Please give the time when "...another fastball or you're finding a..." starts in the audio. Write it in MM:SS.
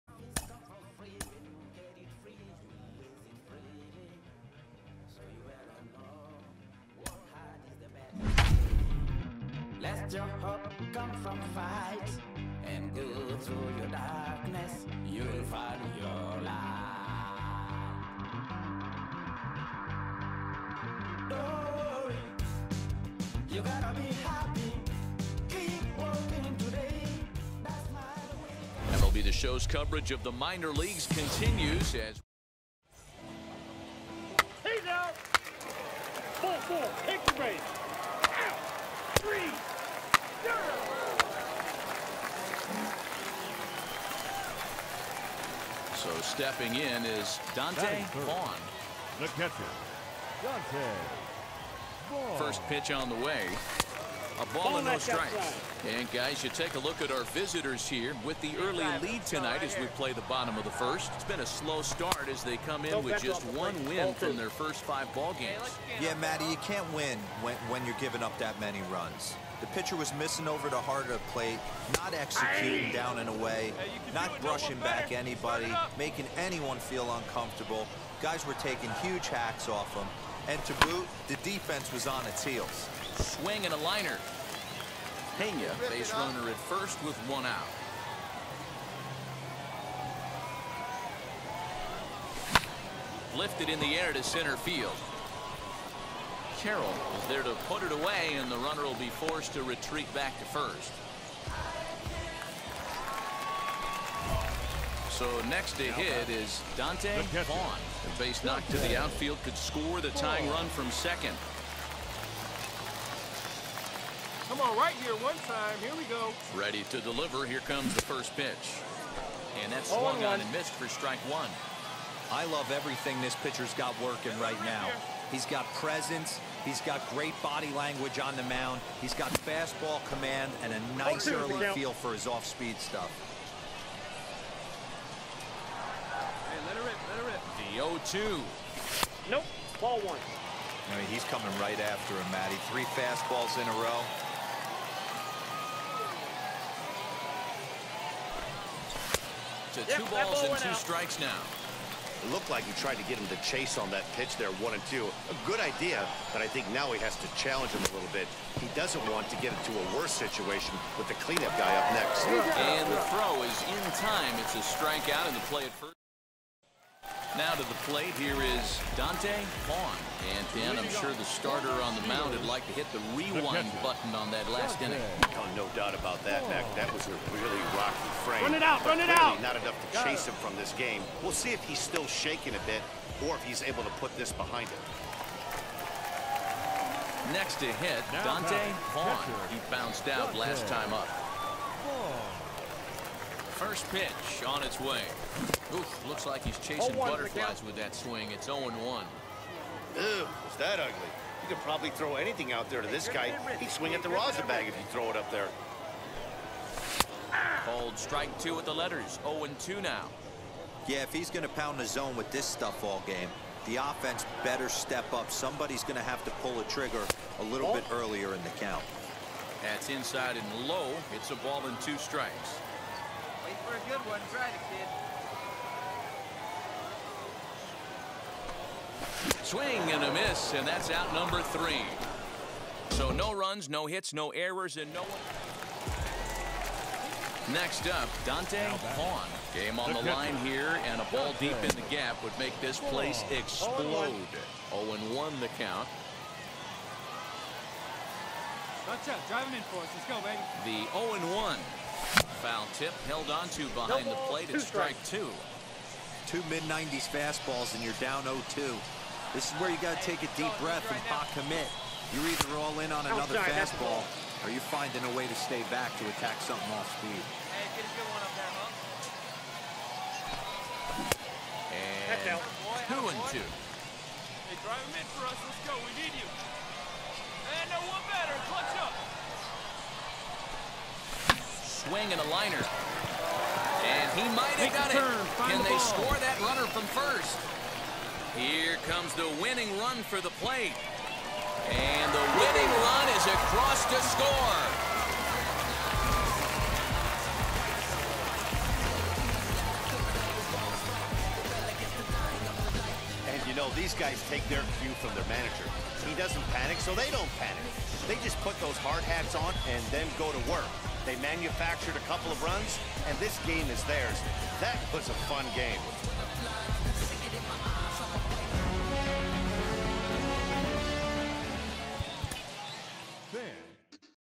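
04:23.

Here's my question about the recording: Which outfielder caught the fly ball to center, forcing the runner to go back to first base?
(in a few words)
Carroll.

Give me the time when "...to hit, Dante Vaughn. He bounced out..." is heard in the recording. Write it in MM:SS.
03:07.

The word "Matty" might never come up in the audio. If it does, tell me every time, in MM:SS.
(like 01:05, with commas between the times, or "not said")
01:06, 02:22.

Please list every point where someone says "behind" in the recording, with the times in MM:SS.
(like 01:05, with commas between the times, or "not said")
03:04, 04:13.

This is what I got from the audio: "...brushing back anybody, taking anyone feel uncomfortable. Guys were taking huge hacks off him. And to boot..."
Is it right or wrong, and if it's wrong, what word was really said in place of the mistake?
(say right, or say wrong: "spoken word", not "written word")
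wrong: "making", not "taking".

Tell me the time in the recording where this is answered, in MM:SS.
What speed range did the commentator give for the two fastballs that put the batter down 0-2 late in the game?
04:16.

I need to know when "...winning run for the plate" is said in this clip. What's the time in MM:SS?
04:49.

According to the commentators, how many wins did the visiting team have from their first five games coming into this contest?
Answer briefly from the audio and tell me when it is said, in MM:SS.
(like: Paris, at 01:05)
1, at 01:03.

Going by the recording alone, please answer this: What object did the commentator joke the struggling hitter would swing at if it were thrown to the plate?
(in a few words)
the rosin bag.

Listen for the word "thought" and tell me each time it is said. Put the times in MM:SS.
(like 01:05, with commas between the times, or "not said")
not said.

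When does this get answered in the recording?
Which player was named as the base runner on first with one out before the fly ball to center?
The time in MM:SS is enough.
01:25.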